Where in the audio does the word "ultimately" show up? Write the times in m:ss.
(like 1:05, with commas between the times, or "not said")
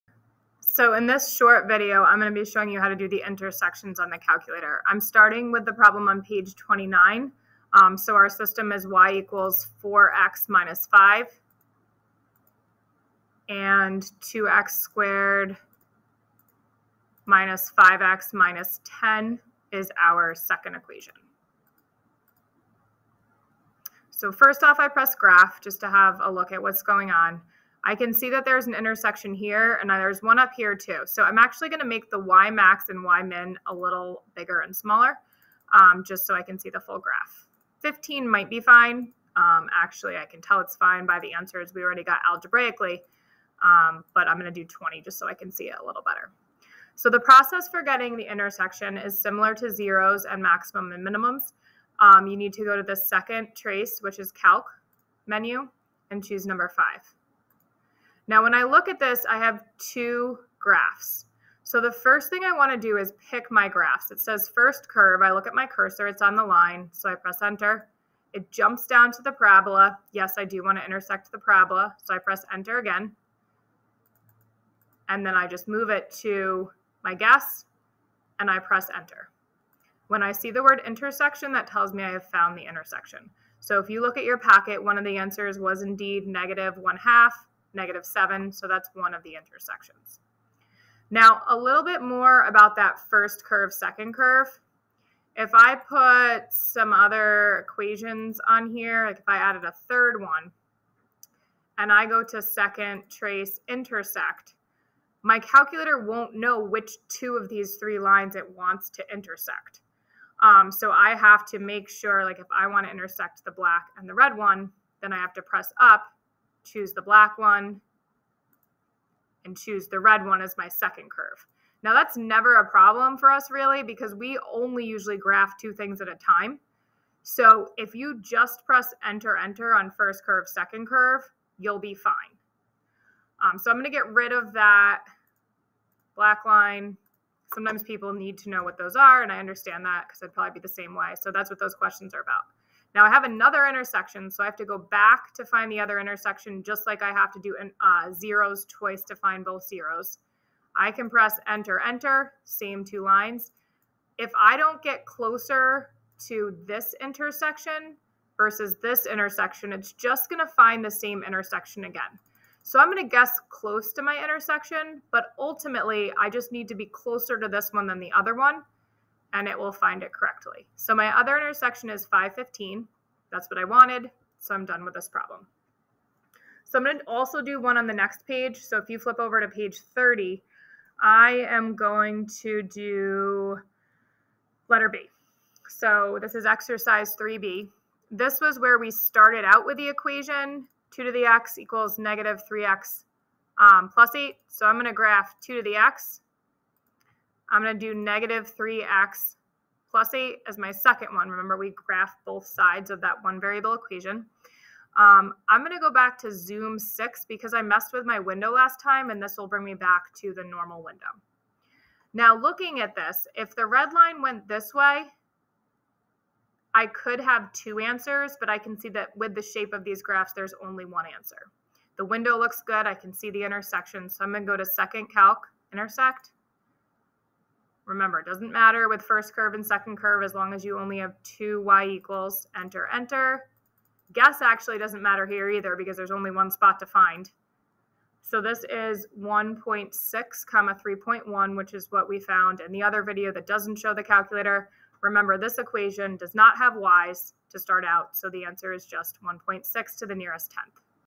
2:45.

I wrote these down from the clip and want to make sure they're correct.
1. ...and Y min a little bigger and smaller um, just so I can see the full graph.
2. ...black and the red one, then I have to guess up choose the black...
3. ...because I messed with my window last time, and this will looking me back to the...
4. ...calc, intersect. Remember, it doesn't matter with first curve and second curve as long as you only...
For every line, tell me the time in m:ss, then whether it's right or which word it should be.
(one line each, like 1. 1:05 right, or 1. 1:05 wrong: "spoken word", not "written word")
1. 0:32 right
2. 1:53 wrong: "press", not "guess"
3. 3:27 wrong: "bring", not "looking"
4. 3:45 right.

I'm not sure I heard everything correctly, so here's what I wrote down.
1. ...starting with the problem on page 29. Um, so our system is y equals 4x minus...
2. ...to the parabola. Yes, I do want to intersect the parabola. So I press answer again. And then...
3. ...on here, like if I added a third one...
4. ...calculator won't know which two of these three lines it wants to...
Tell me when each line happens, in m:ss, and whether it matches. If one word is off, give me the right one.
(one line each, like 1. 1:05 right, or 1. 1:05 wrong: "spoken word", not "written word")
1. 0:05 right
2. 1:09 wrong: "enter", not "answer"
3. 1:38 right
4. 1:45 right.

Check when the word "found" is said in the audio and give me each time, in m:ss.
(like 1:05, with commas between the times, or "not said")
1:22, 4:02.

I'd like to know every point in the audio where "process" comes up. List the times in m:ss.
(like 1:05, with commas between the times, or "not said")
0:47.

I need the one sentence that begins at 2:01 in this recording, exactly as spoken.
Now that's never a problem for us really because we only usually graph two things at a time.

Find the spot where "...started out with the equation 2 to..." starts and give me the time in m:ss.
3:08.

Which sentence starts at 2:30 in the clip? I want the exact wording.
I can press enter, enter, same two lines.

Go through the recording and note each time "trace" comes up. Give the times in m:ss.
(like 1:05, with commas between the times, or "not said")
0:53, 1:43.